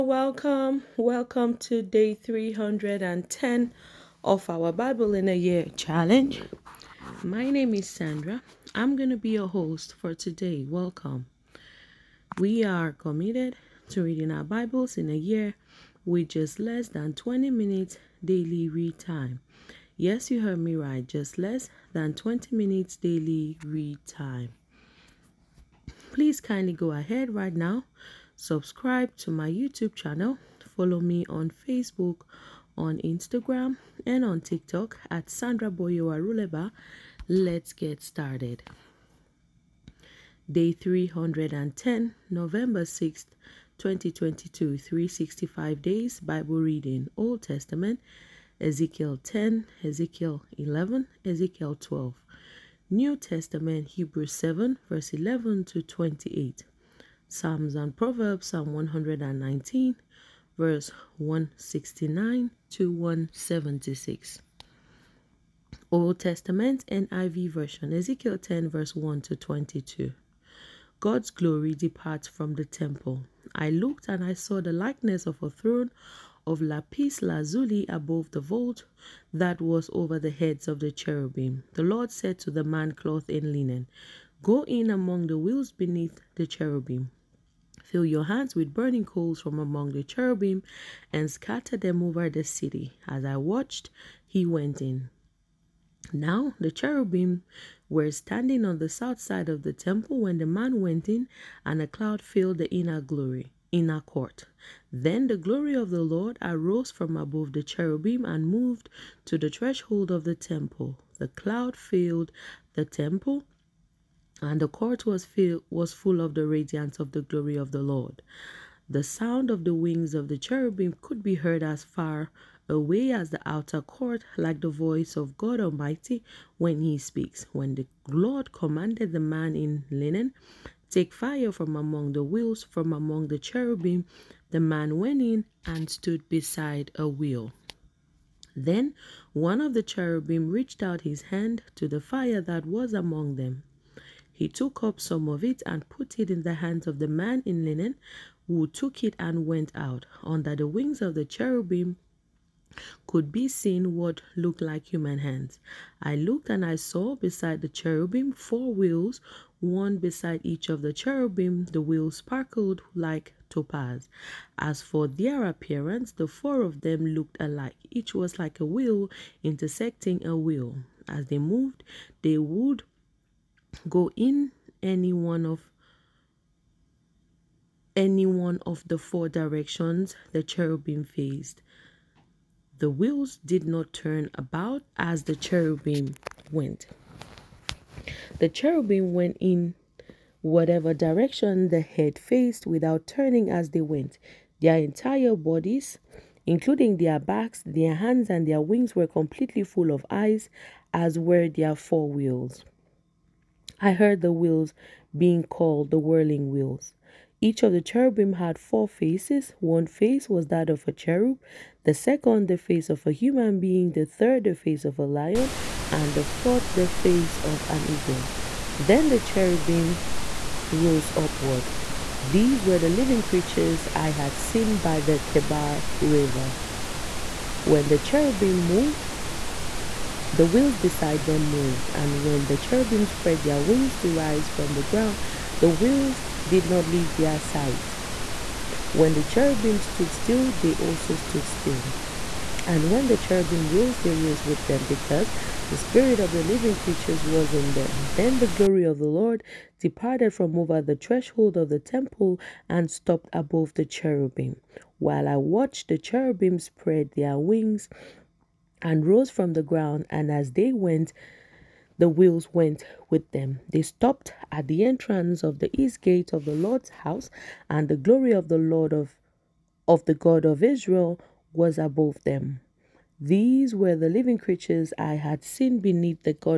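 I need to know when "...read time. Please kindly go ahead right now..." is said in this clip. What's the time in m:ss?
0:23.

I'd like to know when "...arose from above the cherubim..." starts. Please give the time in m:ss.
1:46.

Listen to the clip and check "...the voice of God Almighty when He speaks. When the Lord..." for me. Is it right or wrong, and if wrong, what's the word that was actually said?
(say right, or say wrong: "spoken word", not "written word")
right.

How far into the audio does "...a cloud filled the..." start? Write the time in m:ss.
1:41.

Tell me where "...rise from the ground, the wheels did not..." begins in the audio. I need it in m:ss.
3:54.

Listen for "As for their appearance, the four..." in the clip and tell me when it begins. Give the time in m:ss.
2:44.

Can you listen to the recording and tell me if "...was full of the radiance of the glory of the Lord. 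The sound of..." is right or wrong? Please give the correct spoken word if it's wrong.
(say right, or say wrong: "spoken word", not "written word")
right.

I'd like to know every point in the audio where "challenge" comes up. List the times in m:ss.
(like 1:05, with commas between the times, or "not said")
0:05.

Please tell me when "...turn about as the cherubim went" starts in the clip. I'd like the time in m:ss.
3:03.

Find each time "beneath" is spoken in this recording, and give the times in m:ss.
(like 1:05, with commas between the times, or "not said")
1:25, 4:35.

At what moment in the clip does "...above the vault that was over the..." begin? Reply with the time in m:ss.
1:17.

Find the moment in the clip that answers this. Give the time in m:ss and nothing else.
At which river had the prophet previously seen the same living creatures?
3:45.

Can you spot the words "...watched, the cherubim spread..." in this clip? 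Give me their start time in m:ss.
4:15.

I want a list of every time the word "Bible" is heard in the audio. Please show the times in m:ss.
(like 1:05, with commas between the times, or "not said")
0:04, 0:14, 0:46.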